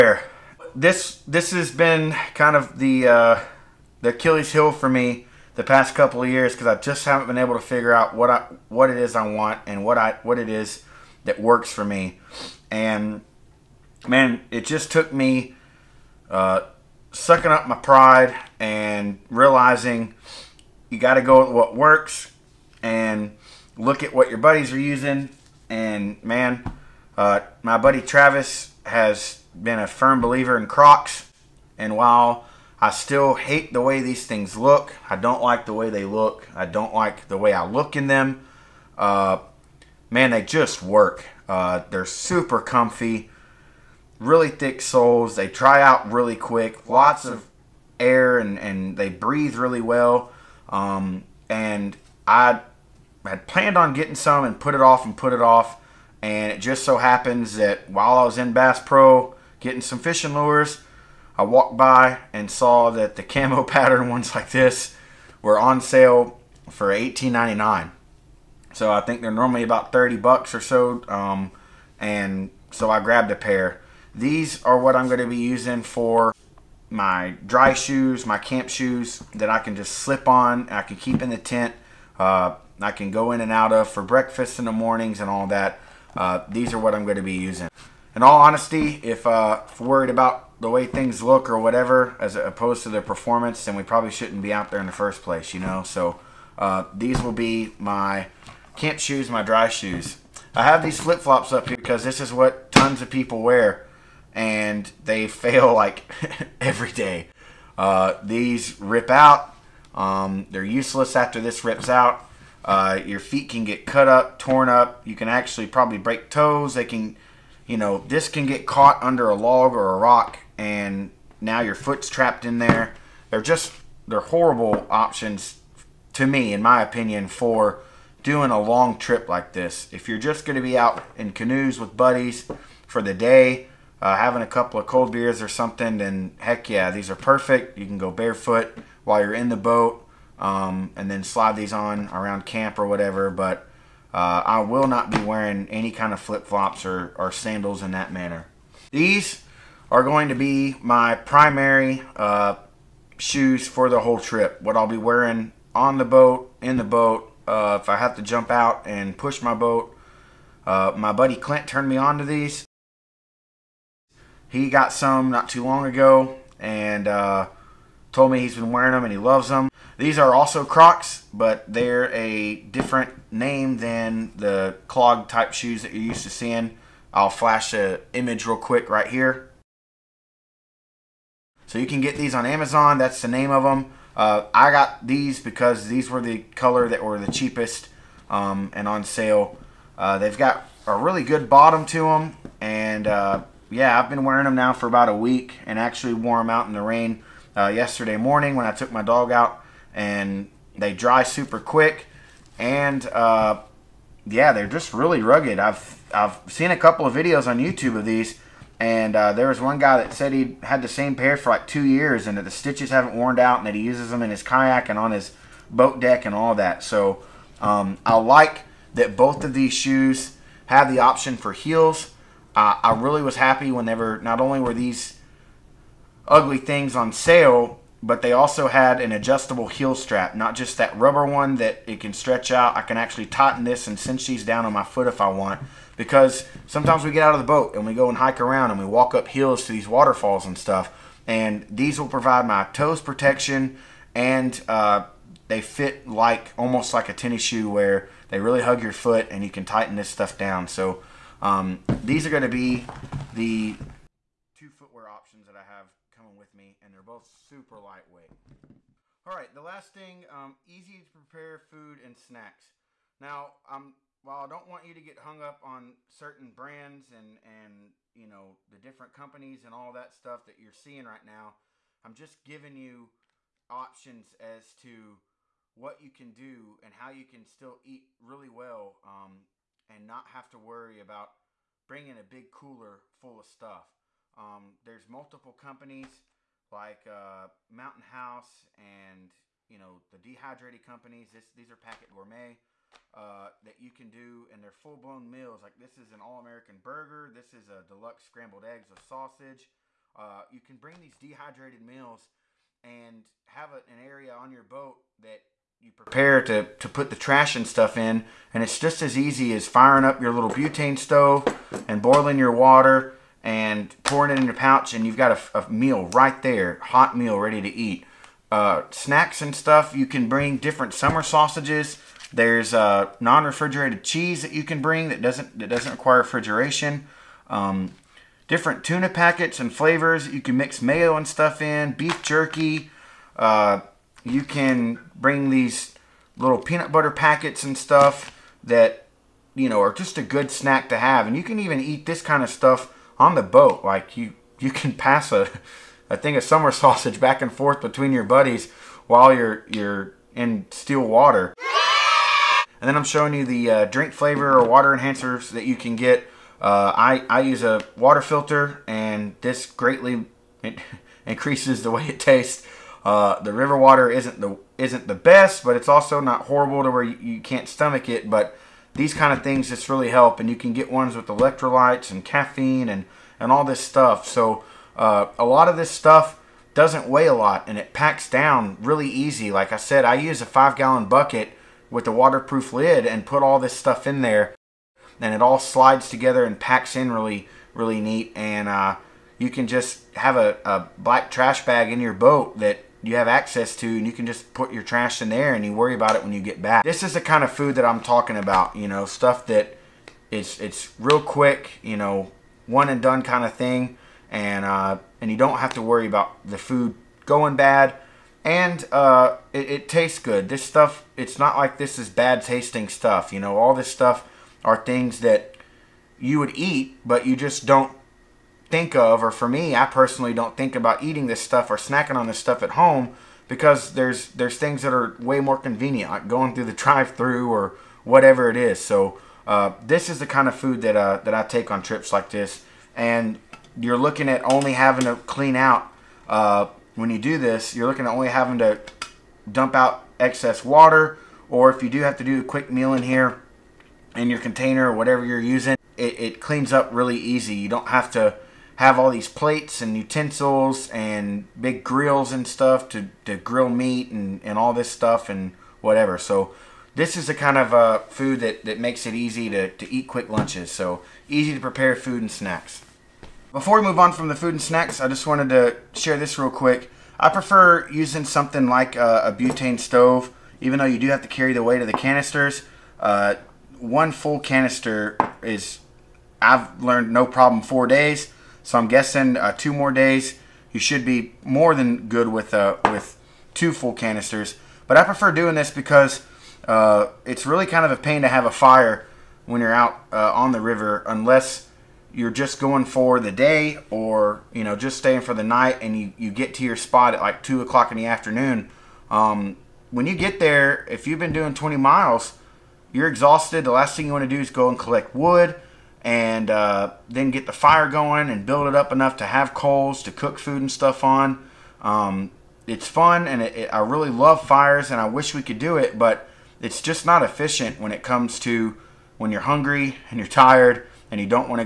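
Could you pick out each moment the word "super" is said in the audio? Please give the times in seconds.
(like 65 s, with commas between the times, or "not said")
42 s, 201 s, 257 s.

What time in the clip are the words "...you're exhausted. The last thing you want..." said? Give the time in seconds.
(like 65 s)
502 s.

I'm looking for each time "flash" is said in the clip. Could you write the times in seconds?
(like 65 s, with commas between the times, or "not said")
177 s.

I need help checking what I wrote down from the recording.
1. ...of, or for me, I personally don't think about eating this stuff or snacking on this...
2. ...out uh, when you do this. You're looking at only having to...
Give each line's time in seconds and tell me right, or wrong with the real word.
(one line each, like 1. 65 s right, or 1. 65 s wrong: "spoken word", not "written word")
1. 418 s right
2. 435 s right.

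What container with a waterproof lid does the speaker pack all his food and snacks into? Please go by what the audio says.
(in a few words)
5 gallon bucket.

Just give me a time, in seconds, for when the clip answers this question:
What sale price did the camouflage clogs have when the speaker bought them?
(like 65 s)
66 s.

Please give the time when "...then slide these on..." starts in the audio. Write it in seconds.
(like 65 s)
141 s.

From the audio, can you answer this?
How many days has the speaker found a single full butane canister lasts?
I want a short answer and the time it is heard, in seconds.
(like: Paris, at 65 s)
4 days, at 477 s.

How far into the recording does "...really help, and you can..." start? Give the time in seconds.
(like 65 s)
369 s.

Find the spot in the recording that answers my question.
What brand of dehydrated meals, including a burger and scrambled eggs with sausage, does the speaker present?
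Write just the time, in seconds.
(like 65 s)
291 s.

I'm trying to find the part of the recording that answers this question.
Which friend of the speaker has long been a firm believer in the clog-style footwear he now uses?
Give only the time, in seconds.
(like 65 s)
28 s.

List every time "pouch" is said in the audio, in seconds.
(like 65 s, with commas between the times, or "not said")
314 s.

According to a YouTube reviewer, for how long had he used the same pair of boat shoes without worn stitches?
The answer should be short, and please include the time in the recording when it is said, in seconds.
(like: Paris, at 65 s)
2 years, at 211 s.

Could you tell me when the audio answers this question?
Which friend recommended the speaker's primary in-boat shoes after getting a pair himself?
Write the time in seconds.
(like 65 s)
161 s.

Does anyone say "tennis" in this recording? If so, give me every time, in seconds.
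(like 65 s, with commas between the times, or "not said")
247 s.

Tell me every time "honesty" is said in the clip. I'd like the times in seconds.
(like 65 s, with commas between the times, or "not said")
88 s.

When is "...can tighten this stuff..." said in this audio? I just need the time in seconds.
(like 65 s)
249 s.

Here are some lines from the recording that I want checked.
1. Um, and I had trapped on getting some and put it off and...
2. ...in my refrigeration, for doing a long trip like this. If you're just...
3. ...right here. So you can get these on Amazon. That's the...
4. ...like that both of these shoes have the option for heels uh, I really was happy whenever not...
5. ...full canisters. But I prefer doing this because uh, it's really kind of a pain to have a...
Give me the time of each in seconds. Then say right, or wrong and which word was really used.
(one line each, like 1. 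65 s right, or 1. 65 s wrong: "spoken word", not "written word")
1. 50 s wrong: "planned", not "trapped"
2. 126 s wrong: "opinion", not "refrigeration"
3. 178 s right
4. 218 s right
5. 483 s right.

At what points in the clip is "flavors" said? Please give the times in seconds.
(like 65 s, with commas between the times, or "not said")
329 s, 354 s.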